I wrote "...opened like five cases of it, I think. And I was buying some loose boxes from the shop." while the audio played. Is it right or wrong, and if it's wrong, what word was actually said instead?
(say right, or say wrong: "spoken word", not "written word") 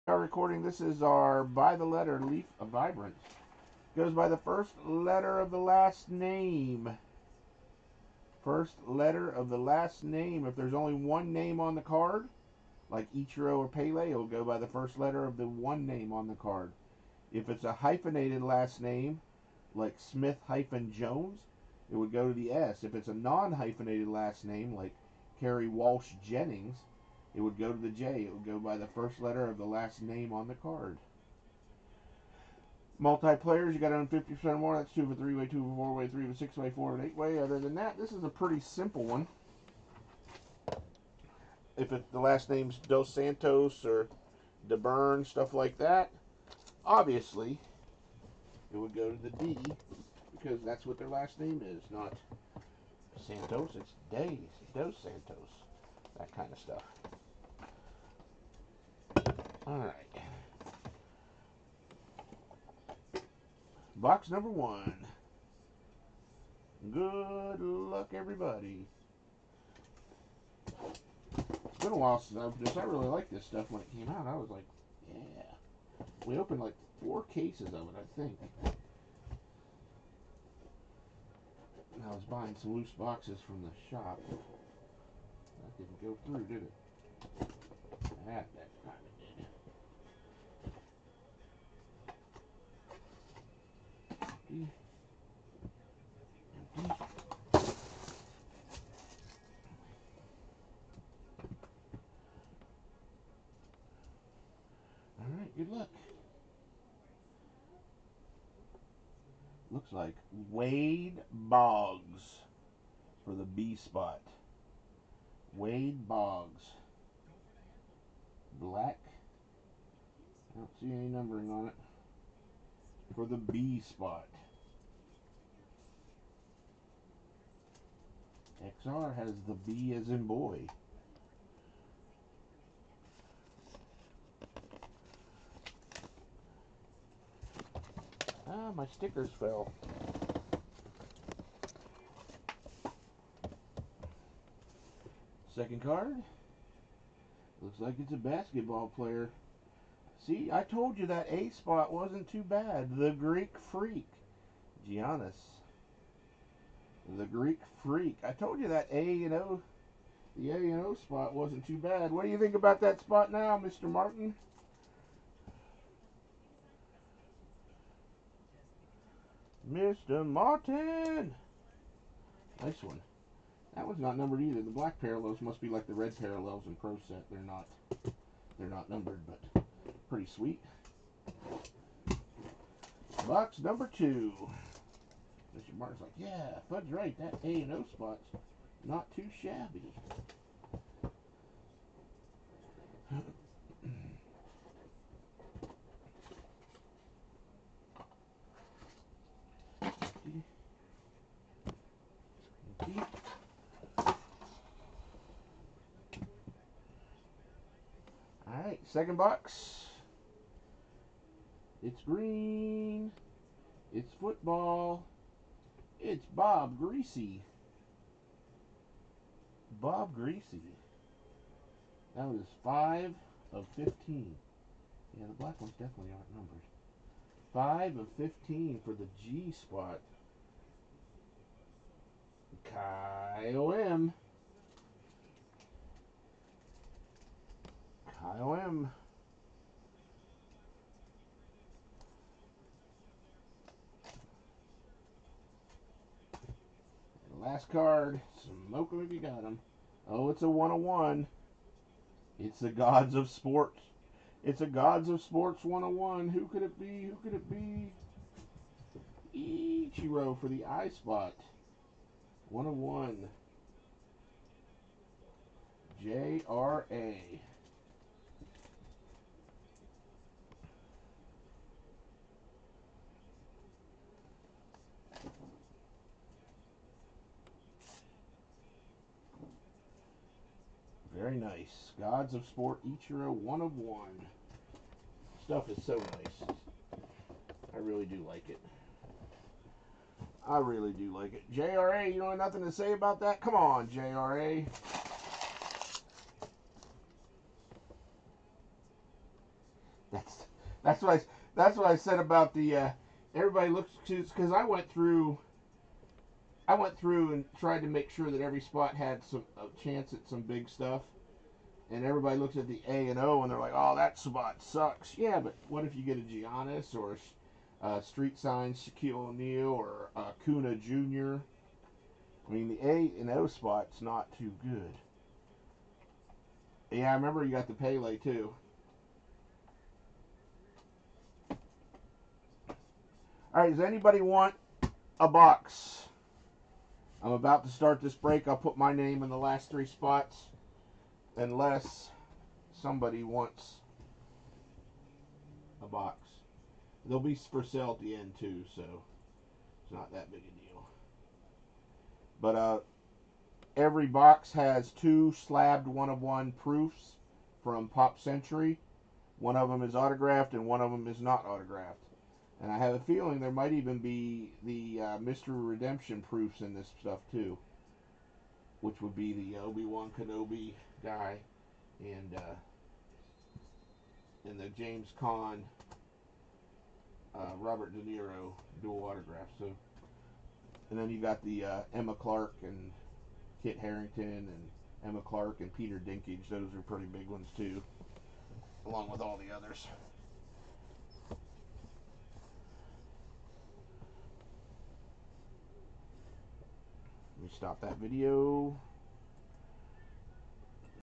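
wrong: "four", not "five".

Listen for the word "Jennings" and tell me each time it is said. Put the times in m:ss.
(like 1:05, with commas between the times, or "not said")
0:26.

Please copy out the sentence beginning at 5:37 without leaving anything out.
I'm about to start this break.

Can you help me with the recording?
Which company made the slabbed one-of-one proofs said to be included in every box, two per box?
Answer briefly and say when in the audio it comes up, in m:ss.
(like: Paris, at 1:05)
Pop Century, at 5:57.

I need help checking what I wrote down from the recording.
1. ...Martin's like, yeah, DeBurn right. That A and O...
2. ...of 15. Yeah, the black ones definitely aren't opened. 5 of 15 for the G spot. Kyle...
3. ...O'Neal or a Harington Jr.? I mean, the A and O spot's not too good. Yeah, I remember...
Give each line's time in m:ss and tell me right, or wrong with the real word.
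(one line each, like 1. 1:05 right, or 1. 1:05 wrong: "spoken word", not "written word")
1. 3:05 wrong: "Fudge", not "DeBurn"
2. 3:43 wrong: "numbered", not "opened"
3. 5:19 wrong: "Kuna", not "Harington".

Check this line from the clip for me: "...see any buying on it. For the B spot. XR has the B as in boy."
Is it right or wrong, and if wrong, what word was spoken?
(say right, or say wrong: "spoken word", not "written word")
wrong: "numbering", not "buying".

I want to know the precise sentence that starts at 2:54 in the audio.
The black parallels must be like the red parallels in Pro Set.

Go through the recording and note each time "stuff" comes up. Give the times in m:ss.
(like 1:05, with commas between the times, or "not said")
0:45, 0:56, 1:13, 4:45, 5:10, 6:06.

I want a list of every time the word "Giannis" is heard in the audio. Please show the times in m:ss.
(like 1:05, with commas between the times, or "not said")
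2:34, 5:16.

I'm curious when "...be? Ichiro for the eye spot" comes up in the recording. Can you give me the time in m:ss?
4:17.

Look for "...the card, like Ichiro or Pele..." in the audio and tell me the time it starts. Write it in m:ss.
0:11.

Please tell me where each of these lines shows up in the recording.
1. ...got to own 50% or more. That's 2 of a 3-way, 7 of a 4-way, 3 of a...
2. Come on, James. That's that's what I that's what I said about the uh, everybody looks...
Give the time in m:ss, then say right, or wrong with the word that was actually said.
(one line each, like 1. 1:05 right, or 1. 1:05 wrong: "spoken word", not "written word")
1. 0:33 wrong: "2", not "7"
2. 4:53 wrong: "JRA", not "James".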